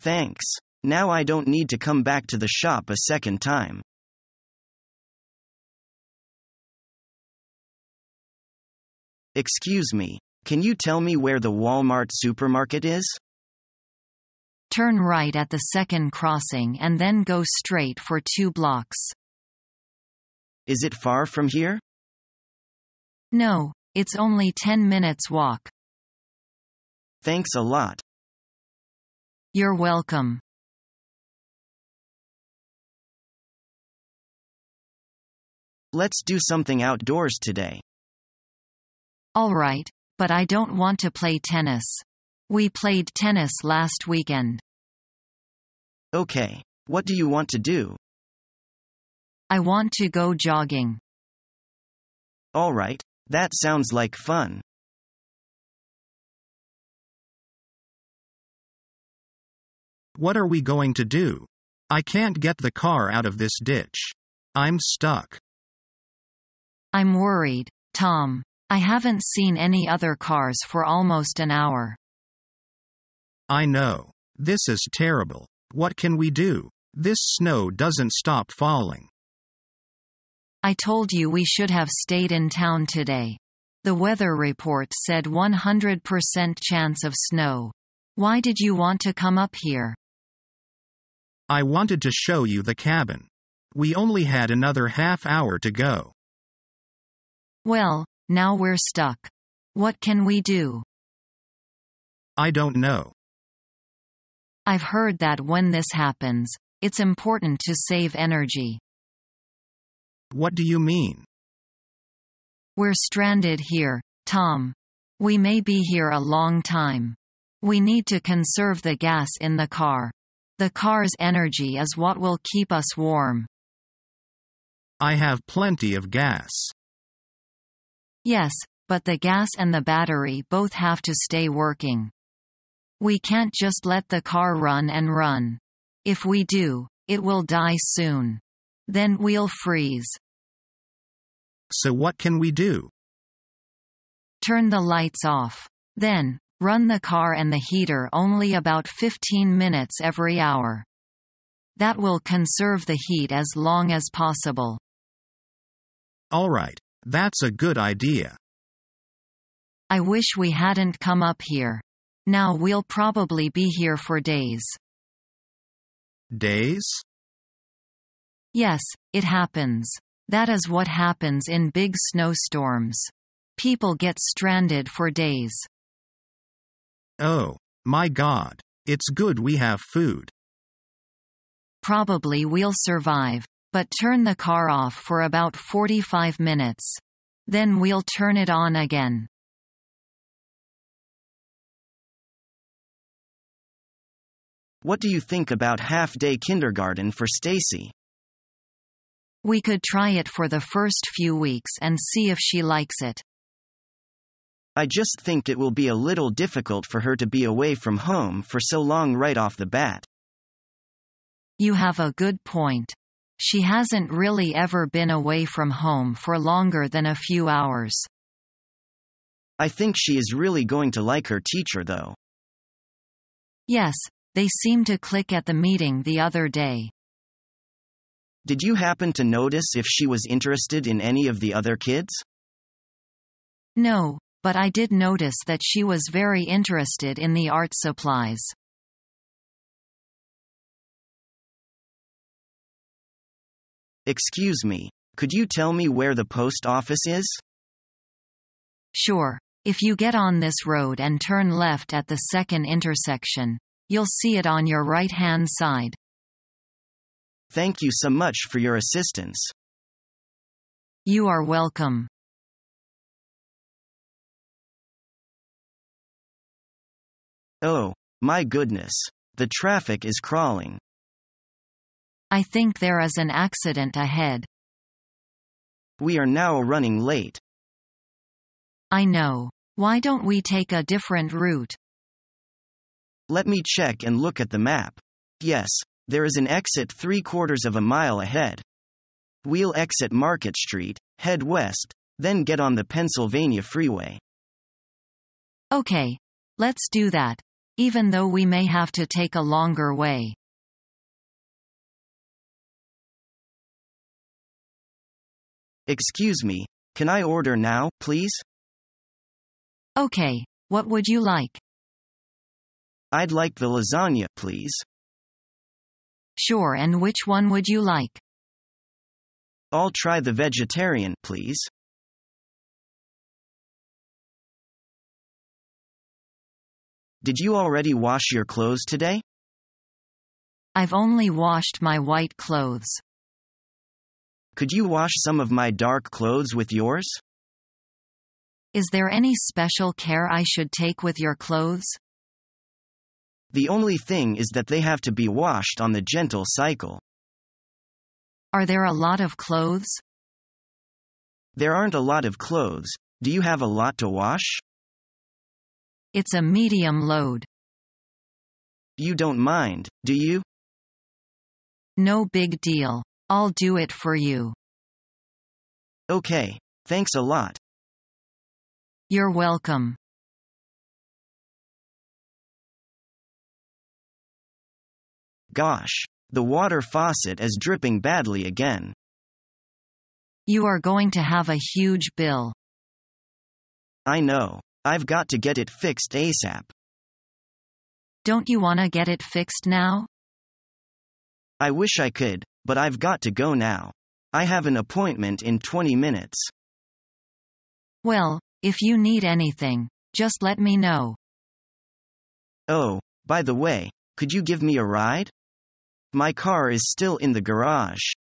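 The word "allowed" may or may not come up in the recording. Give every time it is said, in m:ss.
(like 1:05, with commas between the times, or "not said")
not said.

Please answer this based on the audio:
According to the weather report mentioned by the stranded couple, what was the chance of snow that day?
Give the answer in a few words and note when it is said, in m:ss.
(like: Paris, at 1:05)
100%, at 1:25.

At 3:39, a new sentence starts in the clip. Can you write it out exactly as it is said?
I think she is really going to like her teacher though.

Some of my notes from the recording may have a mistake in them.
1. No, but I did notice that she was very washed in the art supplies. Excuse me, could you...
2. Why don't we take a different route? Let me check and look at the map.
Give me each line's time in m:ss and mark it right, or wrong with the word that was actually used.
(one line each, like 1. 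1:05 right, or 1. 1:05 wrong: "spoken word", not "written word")
1. 3:53 wrong: "interested", not "washed"
2. 4:39 right.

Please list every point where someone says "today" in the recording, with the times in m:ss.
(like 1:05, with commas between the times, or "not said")
0:37, 1:22, 5:28.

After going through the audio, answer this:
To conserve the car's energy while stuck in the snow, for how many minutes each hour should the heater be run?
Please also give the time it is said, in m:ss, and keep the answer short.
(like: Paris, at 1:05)
15 minutes, at 2:28.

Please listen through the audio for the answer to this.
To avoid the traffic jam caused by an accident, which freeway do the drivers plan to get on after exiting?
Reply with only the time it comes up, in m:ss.
4:52.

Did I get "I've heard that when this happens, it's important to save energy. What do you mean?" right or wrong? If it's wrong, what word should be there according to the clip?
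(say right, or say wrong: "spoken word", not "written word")
right.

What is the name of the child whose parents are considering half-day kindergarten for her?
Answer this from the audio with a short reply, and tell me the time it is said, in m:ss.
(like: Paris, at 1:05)
Stacy, at 3:17.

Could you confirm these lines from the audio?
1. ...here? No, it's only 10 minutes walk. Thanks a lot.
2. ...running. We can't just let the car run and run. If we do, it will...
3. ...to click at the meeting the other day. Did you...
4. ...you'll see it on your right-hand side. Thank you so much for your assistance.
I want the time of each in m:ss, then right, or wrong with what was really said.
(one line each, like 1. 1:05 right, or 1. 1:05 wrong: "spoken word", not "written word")
1. 0:21 right
2. 2:11 wrong: "working", not "running"
3. 3:44 right
4. 4:13 right.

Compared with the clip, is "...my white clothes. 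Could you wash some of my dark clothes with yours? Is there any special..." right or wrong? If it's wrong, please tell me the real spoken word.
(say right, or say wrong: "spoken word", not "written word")
right.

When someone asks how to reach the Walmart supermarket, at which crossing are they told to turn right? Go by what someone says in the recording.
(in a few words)
second crossing.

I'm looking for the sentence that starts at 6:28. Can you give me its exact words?
Don't you want to get it fixed now?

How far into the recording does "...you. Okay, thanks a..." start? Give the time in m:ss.
6:04.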